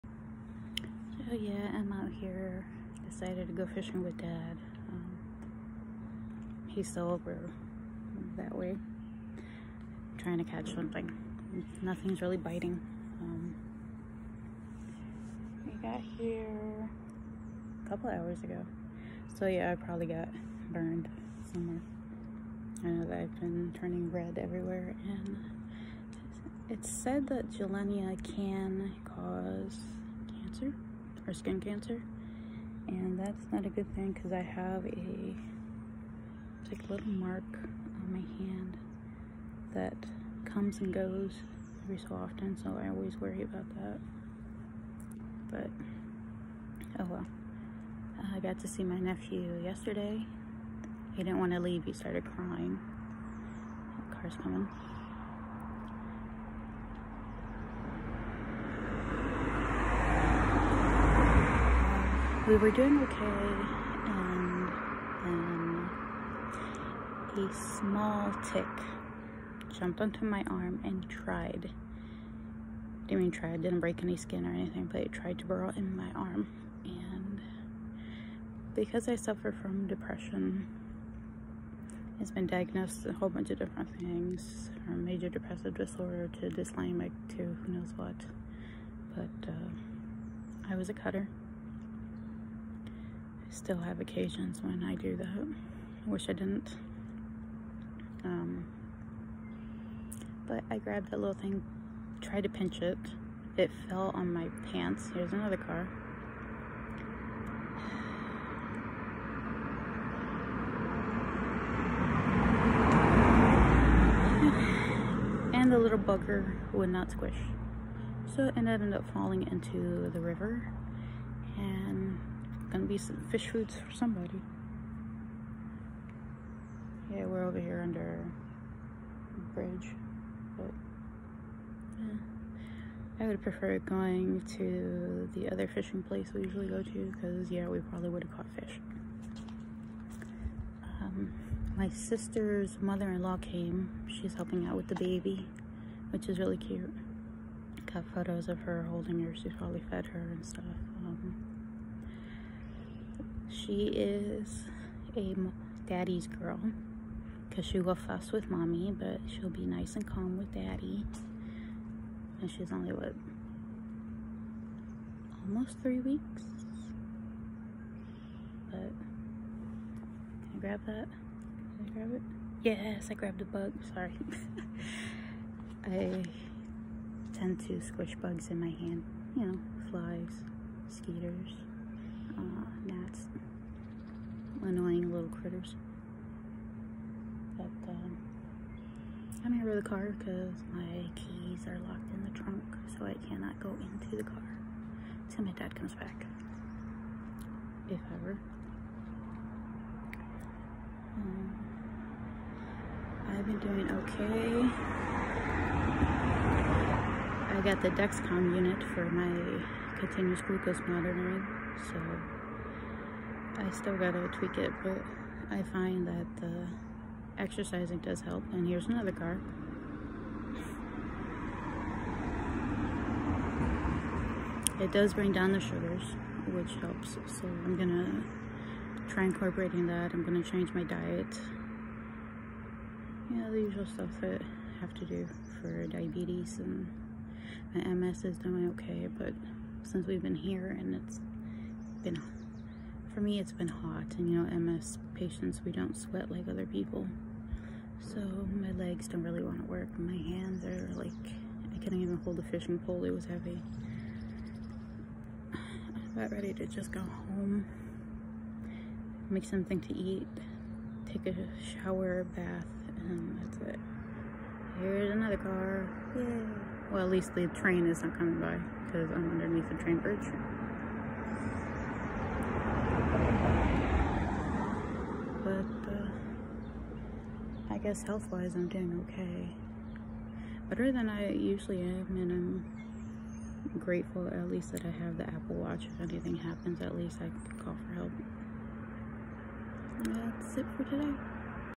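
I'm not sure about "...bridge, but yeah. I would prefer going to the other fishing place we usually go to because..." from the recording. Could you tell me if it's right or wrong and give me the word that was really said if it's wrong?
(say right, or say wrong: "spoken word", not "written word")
right.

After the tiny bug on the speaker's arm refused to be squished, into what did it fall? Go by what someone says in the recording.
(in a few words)
River.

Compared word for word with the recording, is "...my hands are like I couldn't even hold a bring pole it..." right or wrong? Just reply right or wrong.
wrong.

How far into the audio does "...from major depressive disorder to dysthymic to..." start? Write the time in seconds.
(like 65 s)
84 s.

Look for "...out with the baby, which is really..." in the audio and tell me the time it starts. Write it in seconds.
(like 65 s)
144 s.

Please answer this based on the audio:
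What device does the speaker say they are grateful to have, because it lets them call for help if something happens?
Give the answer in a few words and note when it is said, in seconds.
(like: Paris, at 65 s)
Apple Watch, at 285 s.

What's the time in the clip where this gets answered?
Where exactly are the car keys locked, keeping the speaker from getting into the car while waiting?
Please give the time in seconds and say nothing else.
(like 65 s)
192 s.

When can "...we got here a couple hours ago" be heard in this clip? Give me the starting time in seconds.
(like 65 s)
15 s.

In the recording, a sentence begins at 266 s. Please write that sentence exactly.
well at least the train is not coming by because I'm underneath the train bridge guess health-wise I'm doing okay.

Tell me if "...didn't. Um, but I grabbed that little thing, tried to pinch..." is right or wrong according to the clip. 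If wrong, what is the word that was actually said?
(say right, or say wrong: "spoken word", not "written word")
right.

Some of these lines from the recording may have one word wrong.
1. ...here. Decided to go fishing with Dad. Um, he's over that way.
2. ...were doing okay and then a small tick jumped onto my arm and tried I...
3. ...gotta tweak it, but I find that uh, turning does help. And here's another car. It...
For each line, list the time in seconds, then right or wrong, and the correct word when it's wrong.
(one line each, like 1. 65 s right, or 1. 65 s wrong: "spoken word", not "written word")
1. 2 s right
2. 62 s right
3. 213 s wrong: "exercising", not "turning".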